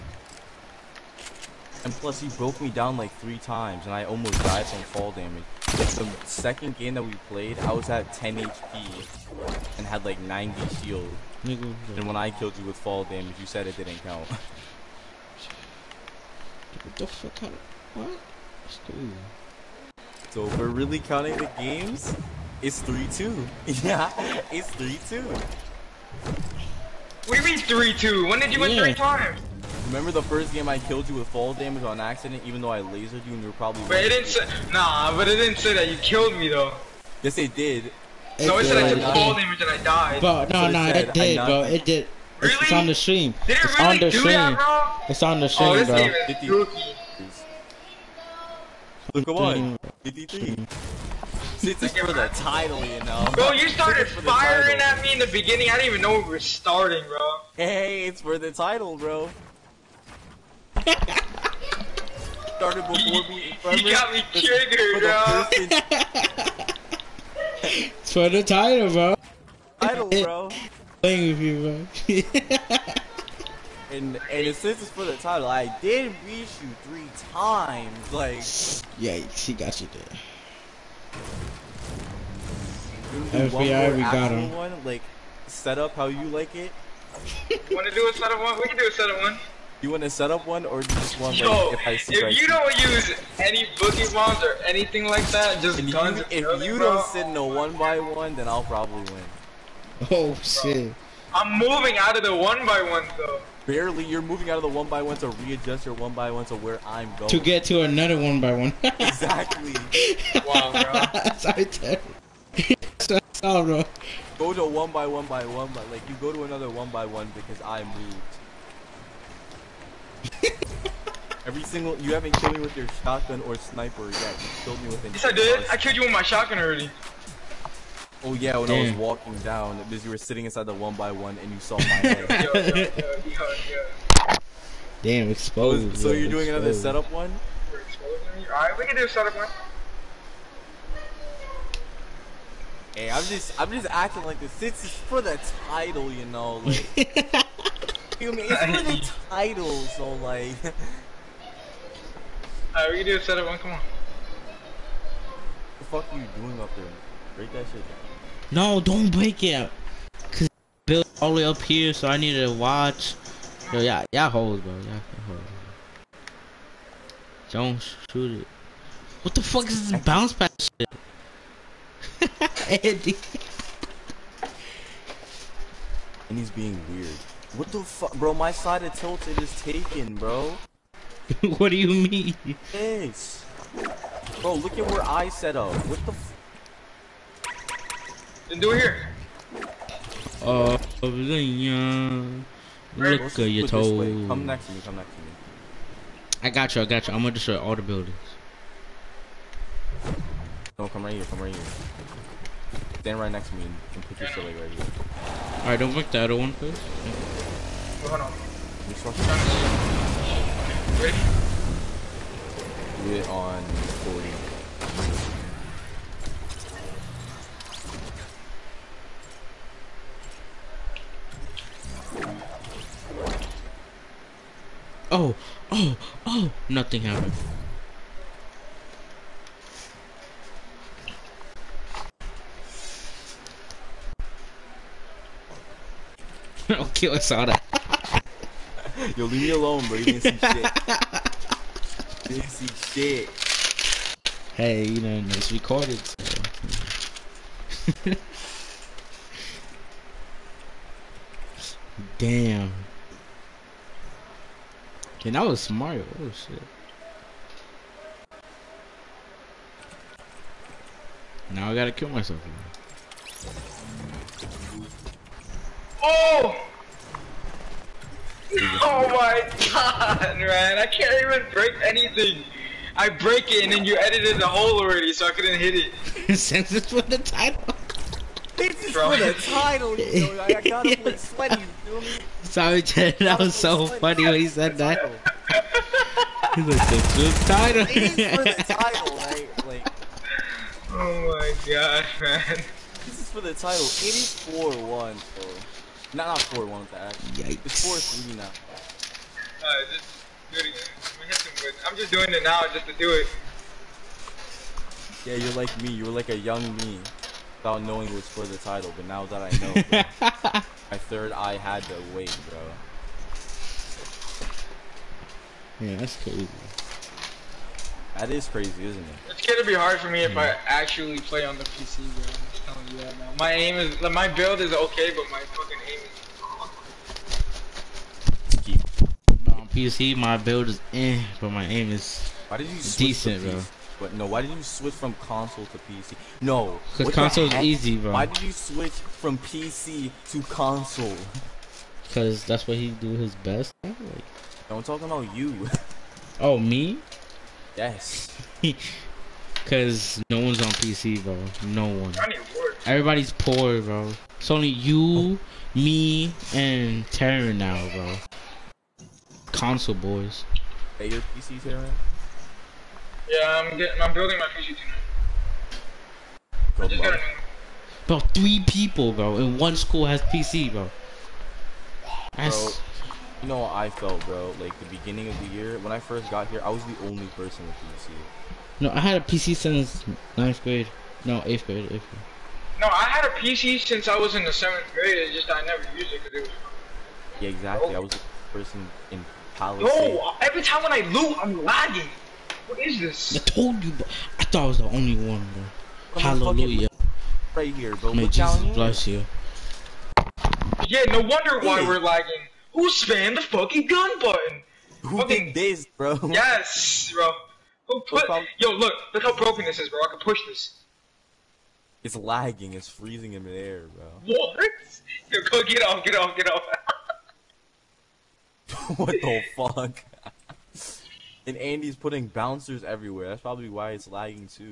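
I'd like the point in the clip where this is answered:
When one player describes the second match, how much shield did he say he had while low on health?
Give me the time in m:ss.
0:10.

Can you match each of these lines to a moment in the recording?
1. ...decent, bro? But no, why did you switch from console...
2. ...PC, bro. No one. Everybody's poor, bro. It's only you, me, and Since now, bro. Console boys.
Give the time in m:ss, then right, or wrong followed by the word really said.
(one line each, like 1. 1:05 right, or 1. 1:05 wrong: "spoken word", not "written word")
1. 5:32 right
2. 5:50 wrong: "Tarrin", not "Since".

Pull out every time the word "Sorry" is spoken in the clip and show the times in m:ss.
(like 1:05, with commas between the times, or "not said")
4:42.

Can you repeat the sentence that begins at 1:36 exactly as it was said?
You, if you bro, don't sit in a one by one, then I'll probably win.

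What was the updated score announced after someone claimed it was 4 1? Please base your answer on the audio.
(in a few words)
4 3.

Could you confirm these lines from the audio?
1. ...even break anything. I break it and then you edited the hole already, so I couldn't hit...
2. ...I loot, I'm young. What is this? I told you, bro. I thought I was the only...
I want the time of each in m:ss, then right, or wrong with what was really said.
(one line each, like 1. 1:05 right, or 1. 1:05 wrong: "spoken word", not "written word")
1. 4:31 right
2. 6:30 wrong: "lagging", not "young".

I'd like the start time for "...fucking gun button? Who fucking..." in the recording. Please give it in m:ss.
6:43.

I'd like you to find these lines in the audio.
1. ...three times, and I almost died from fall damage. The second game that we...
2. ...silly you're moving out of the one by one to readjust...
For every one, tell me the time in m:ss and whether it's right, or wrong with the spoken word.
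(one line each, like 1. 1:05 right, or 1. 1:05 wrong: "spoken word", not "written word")
1. 0:03 right
2. 1:43 wrong: "barely", not "silly".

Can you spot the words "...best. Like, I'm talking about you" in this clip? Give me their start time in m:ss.
5:43.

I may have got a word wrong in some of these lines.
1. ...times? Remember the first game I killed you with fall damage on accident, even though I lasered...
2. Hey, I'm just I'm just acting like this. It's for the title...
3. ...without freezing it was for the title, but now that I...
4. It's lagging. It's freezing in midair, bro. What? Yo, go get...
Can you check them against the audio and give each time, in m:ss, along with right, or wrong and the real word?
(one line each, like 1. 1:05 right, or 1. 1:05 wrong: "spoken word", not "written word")
1. 0:28 right
2. 2:22 right
3. 5:07 wrong: "knowing", not "freezing"
4. 6:52 right.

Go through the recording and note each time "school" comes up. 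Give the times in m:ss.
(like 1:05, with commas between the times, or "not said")
6:09.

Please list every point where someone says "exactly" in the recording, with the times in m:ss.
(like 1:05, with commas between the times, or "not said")
1:48, 6:27.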